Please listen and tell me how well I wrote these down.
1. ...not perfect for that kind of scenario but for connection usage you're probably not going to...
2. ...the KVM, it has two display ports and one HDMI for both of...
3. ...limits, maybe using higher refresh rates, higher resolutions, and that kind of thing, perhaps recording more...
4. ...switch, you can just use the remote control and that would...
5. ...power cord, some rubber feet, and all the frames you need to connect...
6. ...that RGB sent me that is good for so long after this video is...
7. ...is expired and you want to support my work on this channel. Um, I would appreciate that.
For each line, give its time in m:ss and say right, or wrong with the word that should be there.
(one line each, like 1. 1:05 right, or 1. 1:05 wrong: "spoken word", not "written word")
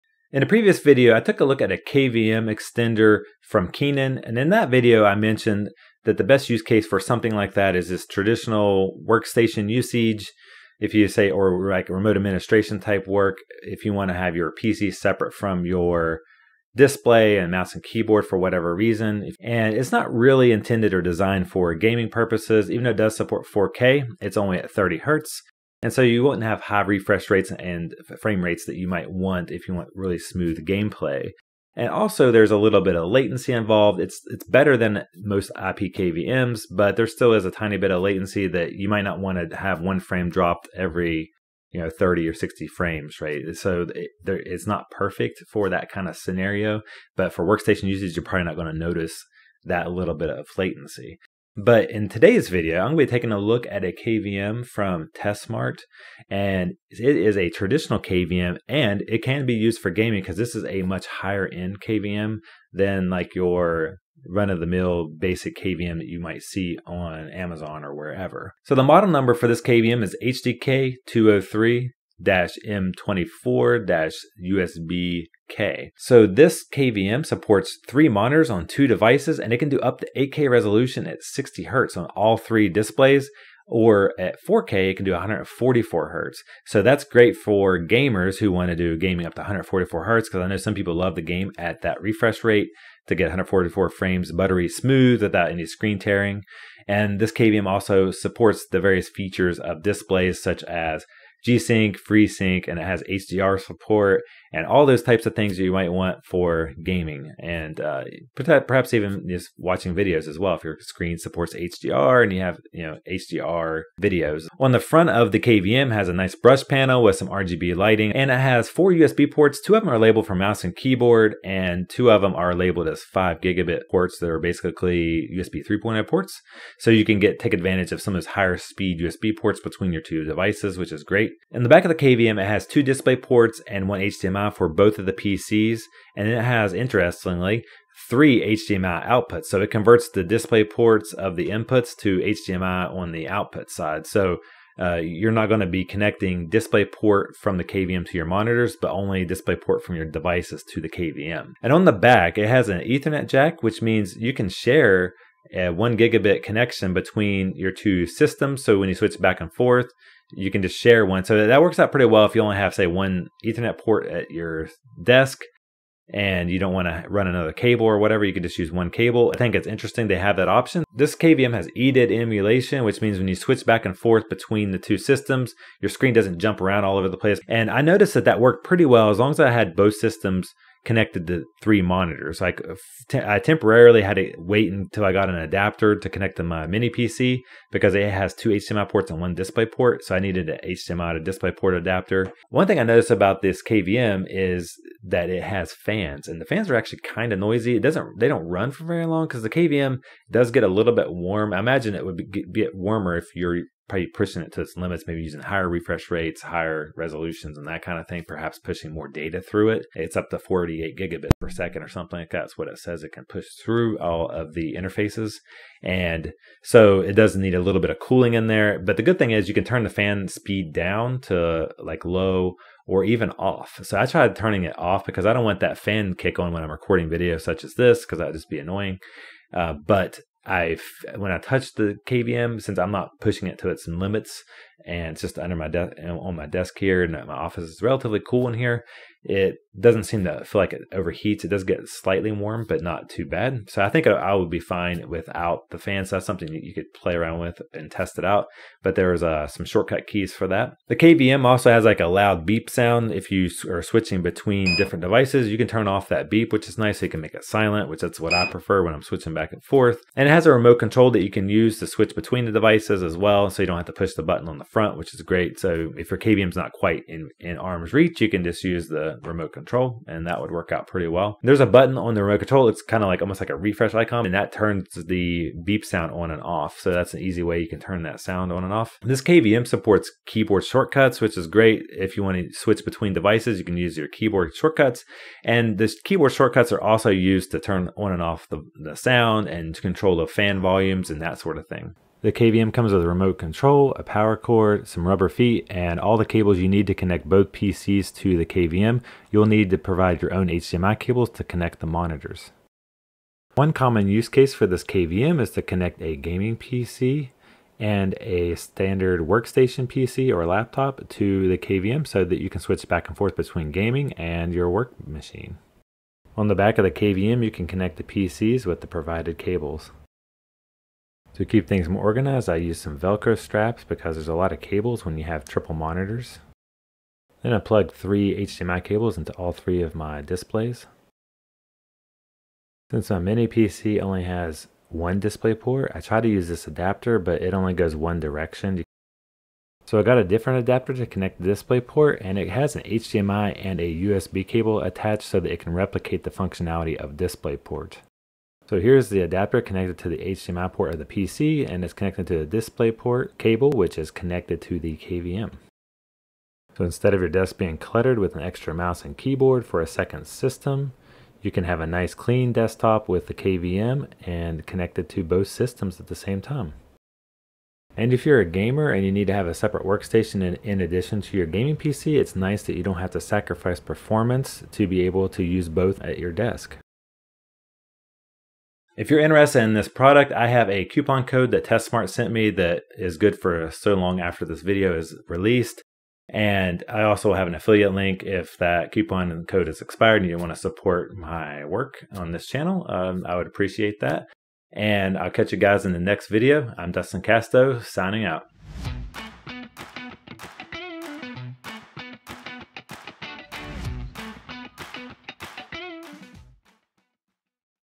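1. 0:44 wrong: "workstation", not "connection"
2. 2:11 right
3. 3:24 wrong: "pushing", not "recording"
4. 4:27 wrong: "reach", not "switch"
5. 4:54 wrong: "cables", not "frames"
6. 6:21 wrong: "TESmart", not "RGB"
7. 6:29 right.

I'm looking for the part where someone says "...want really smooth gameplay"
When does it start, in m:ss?
0:29.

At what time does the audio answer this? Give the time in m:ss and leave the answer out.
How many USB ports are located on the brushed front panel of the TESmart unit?
1:58.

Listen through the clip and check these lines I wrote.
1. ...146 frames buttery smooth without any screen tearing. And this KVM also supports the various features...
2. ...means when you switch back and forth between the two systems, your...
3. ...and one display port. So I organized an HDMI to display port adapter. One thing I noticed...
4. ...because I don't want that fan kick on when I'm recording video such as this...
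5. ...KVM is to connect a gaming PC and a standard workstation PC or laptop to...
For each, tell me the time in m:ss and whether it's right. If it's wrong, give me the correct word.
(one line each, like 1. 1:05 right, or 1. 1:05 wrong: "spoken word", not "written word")
1. 1:33 wrong: "144", not "146"
2. 2:53 right
3. 3:09 wrong: "needed", not "organized"
4. 3:45 right
5. 5:04 right.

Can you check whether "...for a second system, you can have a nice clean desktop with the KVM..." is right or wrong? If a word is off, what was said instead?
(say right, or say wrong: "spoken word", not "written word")
right.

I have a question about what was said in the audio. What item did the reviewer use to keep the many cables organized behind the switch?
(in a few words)
Velcro straps.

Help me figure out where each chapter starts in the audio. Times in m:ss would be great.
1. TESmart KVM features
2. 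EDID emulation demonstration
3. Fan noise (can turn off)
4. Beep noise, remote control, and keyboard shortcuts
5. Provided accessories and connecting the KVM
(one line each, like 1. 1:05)
1. 0:51
2. 2:50
3. 3:12
4. 4:10
5. 4:51.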